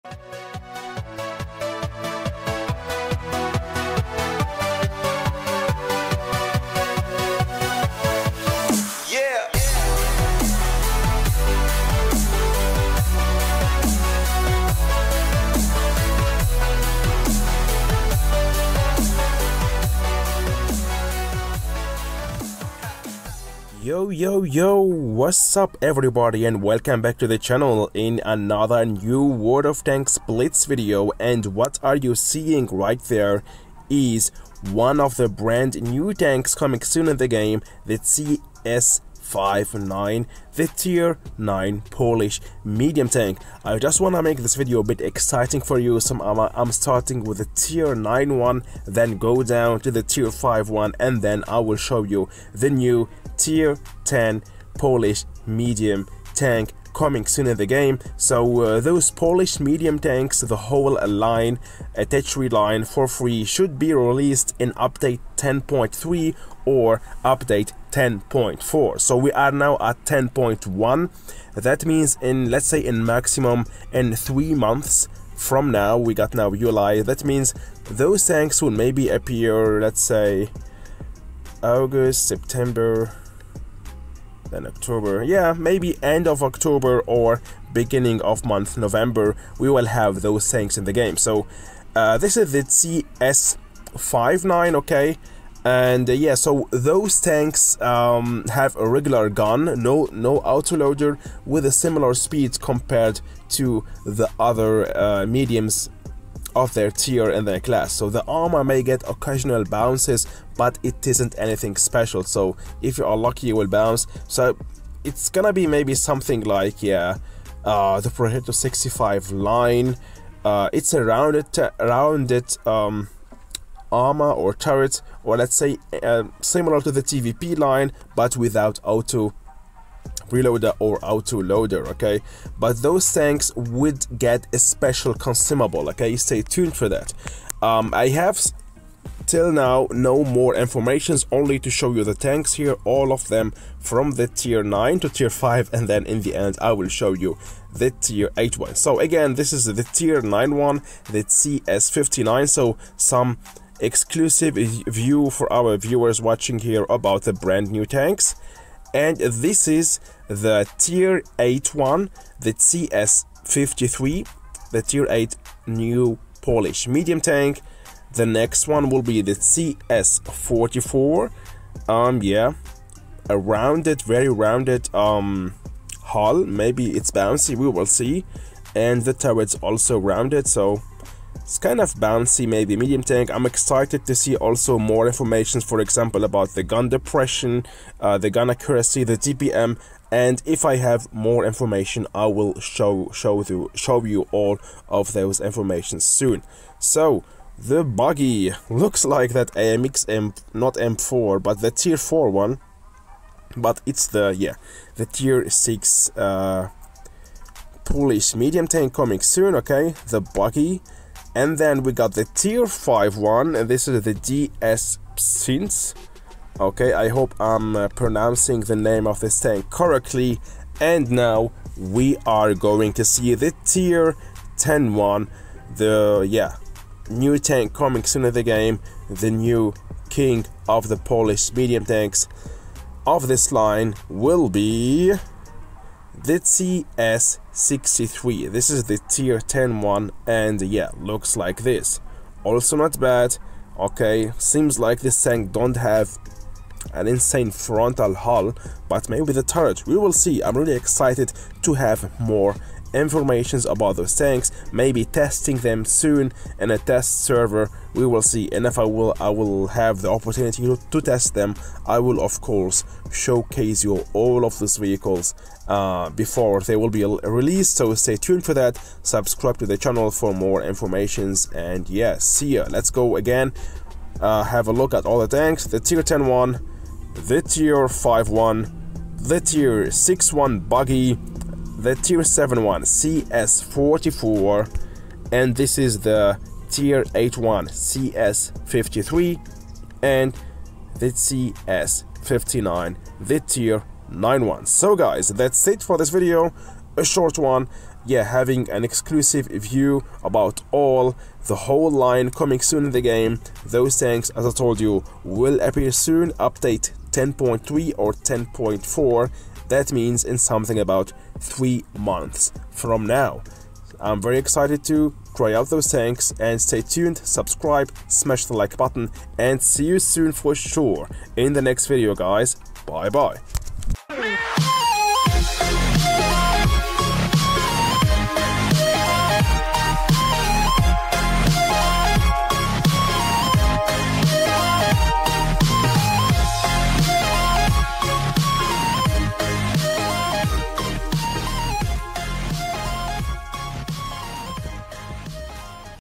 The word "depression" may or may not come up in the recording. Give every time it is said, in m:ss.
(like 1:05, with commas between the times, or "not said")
3:06.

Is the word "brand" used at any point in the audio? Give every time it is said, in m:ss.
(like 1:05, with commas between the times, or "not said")
0:35, 2:37.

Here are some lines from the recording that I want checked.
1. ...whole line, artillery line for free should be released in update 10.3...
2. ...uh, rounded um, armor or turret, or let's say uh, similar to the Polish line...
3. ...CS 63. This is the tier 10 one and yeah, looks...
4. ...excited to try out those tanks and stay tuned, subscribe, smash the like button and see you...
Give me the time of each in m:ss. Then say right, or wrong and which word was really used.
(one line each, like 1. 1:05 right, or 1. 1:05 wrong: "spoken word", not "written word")
1. 1:00 right
2. 2:01 wrong: "TVP", not "Polish"
3. 3:56 right
4. 5:14 right.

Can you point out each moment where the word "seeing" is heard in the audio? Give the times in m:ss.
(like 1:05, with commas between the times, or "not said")
0:32.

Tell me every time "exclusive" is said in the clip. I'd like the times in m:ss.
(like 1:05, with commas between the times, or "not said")
2:33, 4:58.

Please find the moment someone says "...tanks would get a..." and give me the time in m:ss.
2:13.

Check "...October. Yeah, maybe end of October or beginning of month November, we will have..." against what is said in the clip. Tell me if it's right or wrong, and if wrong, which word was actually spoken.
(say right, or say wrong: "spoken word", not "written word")
right.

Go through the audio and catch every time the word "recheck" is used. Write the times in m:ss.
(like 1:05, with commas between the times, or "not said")
not said.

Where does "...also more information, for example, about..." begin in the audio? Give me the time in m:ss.
3:04.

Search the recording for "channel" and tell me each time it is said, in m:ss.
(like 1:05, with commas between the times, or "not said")
0:27, 4:29.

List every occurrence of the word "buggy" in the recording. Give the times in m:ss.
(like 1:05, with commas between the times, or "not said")
3:17, 3:30, 4:40.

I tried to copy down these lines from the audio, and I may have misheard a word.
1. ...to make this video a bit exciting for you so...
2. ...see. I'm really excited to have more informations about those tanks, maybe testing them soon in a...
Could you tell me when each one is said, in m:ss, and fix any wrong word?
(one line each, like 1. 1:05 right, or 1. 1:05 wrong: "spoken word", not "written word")
1. 0:44 right
2. 4:10 right.